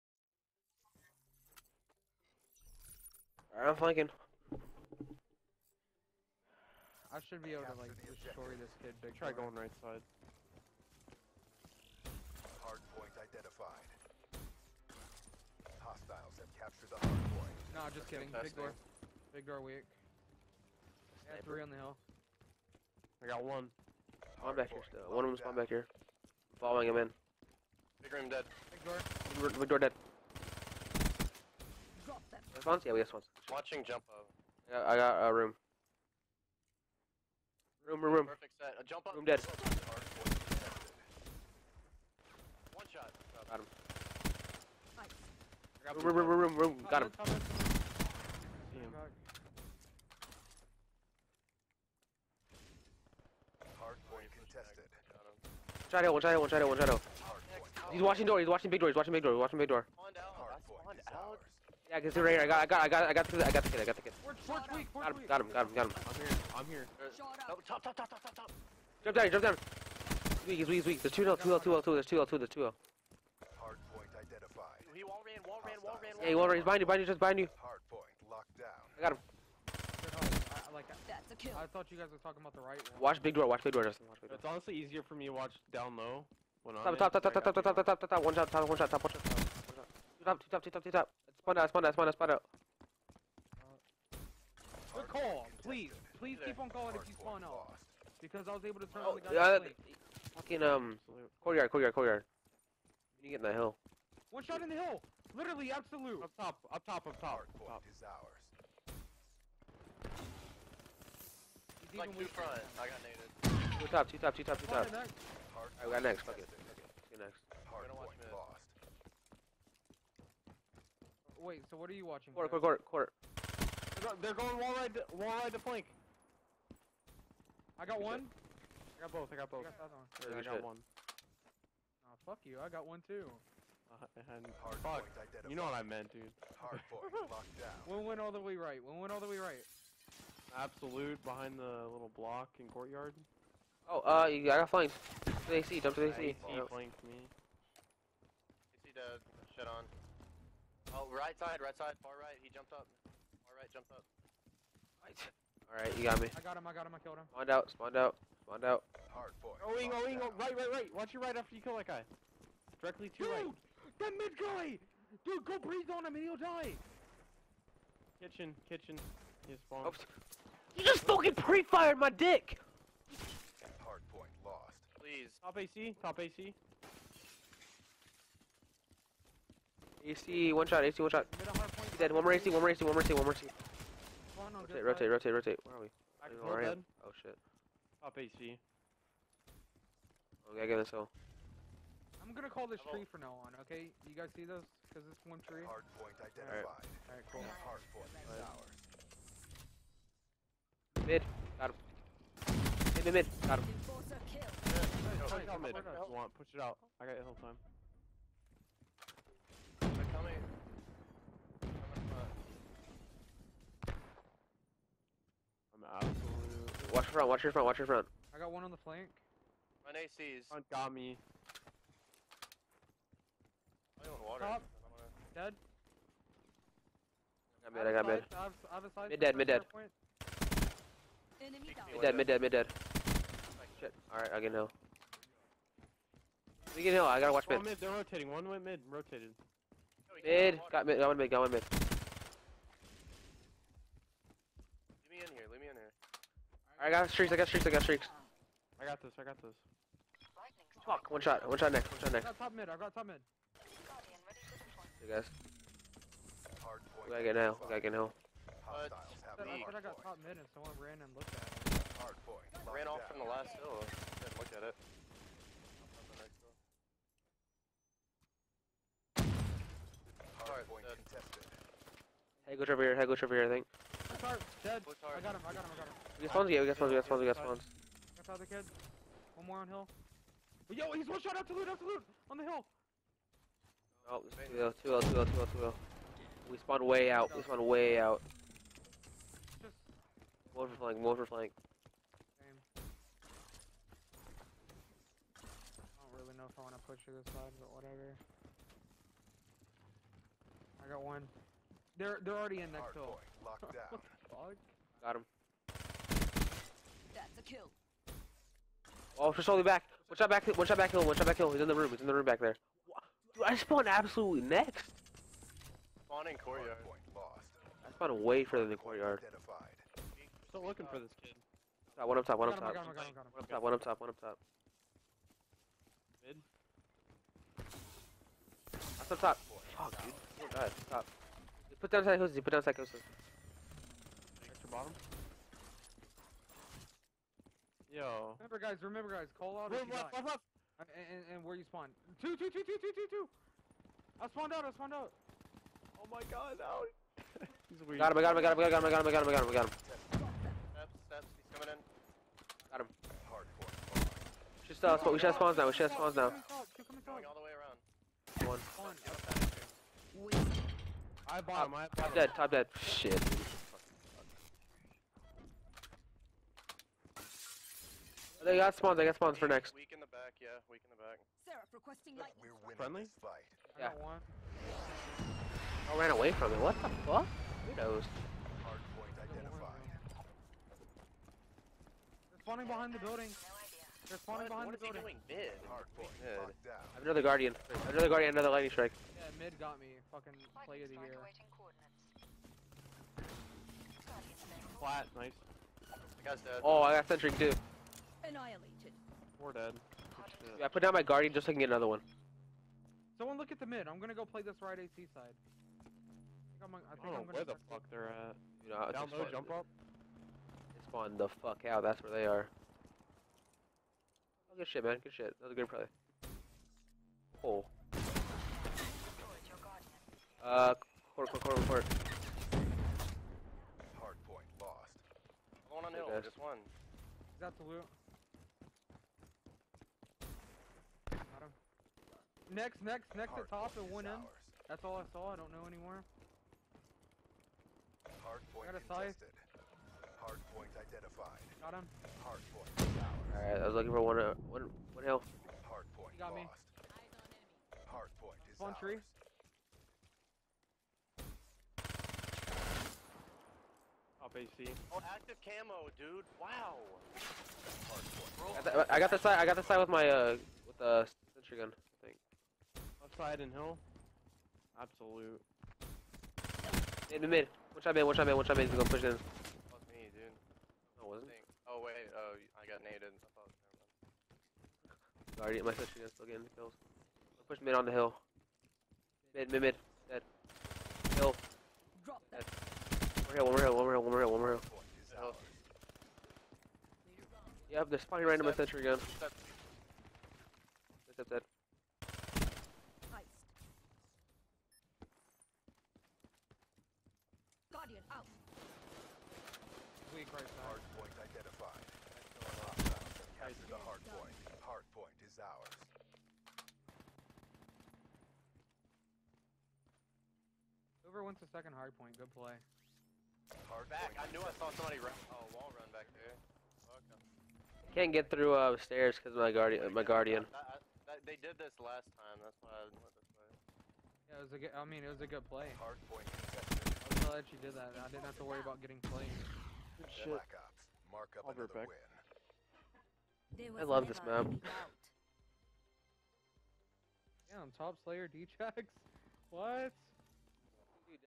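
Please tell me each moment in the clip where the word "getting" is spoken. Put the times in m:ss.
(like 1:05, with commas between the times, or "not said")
7:56, 8:48.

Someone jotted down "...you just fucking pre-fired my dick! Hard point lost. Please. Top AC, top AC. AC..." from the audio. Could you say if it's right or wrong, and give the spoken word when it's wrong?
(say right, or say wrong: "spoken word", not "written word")
right.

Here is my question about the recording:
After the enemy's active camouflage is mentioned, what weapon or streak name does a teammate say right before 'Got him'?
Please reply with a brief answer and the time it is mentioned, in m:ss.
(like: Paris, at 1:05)
Scythe, at 7:19.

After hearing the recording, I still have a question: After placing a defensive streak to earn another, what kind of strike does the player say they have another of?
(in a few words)
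Lightning Strike.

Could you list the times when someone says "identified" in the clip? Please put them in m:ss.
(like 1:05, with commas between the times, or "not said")
0:13, 1:14, 3:16, 6:19.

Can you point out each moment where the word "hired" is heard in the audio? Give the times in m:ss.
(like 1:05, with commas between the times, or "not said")
not said.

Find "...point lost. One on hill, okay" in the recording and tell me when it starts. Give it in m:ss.
7:04.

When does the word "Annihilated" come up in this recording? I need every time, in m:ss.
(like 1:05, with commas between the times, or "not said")
6:38.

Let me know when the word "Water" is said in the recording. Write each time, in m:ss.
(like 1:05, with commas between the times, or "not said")
3:44.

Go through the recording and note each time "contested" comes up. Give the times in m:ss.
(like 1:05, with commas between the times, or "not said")
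0:54, 4:30, 7:18.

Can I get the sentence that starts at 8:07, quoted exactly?
Yep, they're spawning random at sentry gun.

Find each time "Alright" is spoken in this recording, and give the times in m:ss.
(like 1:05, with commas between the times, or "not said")
1:54, 2:35, 3:16, 3:54, 7:22.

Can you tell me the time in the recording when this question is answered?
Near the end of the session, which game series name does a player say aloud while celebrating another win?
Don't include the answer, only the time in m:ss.
8:50.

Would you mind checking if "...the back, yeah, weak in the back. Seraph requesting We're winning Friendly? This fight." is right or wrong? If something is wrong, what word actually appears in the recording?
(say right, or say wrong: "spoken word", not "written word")
right.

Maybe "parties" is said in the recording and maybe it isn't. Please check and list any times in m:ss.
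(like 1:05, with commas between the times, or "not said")
not said.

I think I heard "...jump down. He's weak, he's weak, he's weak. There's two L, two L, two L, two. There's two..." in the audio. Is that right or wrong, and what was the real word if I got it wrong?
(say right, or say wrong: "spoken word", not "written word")
right.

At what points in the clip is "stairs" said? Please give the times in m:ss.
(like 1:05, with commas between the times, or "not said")
8:38.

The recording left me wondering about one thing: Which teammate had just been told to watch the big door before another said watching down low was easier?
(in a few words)
Justin.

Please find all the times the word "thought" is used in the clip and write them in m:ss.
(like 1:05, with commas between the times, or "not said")
1:21, 7:53.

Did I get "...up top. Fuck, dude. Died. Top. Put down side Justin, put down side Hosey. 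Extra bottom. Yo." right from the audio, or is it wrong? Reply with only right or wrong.
wrong.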